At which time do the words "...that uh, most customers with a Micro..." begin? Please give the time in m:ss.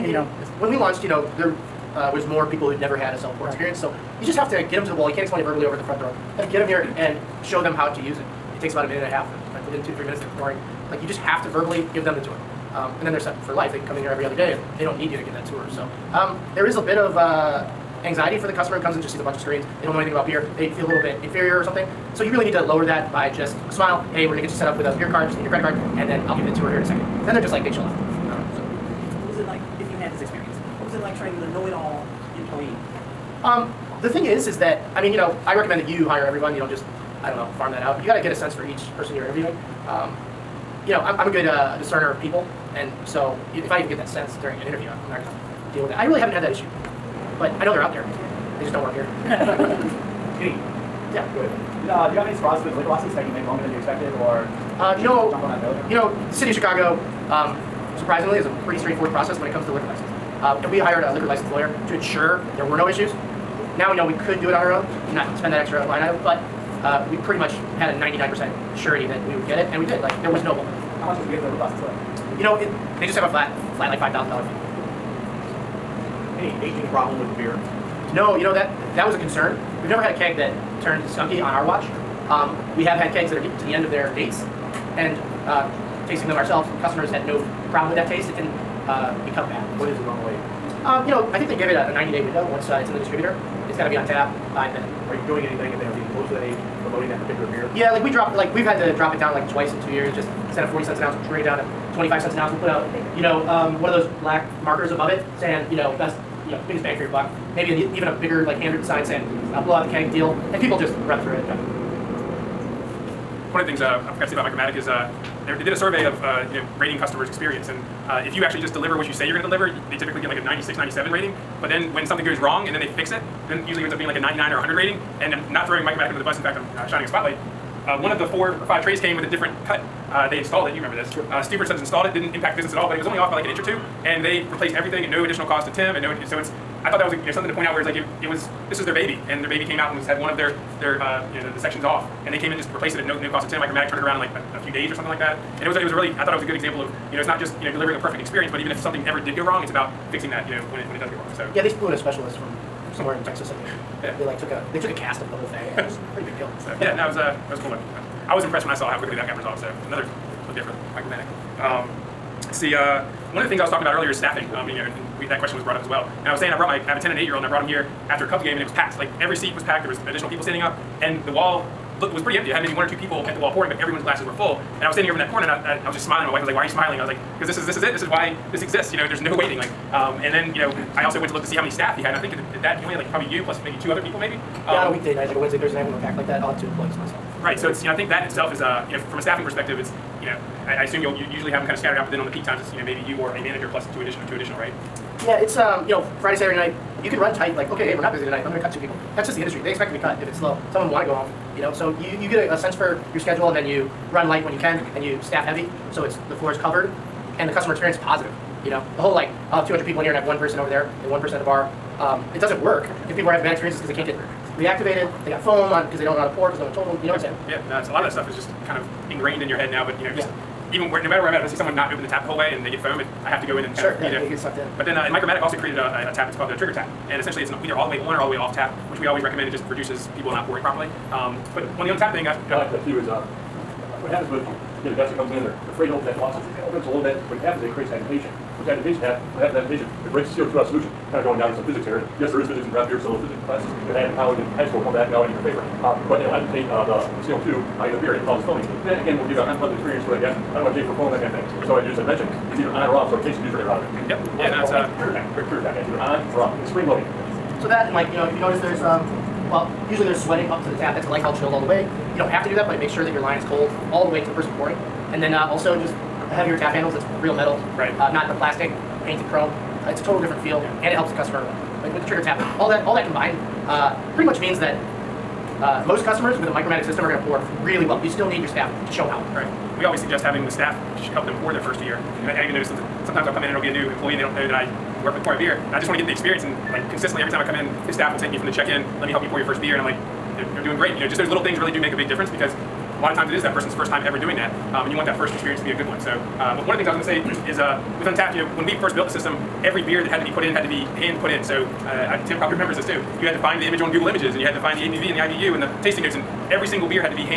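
4:34.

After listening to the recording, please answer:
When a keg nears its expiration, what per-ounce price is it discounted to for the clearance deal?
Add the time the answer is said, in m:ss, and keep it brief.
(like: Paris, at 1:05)
25 cents an ounce, at 1:41.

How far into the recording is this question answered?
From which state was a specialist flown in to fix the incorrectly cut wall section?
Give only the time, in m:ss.
2:33.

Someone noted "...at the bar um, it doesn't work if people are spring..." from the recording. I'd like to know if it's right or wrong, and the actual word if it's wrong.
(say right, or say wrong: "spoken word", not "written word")
wrong: "having", not "spring".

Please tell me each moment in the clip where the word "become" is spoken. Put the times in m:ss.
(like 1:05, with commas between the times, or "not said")
1:29.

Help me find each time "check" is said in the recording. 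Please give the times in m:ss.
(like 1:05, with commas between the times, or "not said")
4:48.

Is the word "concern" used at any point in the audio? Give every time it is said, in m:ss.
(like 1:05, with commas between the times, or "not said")
1:19.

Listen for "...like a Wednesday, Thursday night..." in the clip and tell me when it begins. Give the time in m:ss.
3:05.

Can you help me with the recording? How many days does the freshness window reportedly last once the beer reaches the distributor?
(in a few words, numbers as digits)
90.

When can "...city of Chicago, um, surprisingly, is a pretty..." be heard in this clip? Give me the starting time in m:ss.
0:56.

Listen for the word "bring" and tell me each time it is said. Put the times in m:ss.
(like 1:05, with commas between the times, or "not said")
1:41.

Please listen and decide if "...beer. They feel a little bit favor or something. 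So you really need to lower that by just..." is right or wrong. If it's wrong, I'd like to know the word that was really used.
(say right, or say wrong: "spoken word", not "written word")
wrong: "inferior", not "favor".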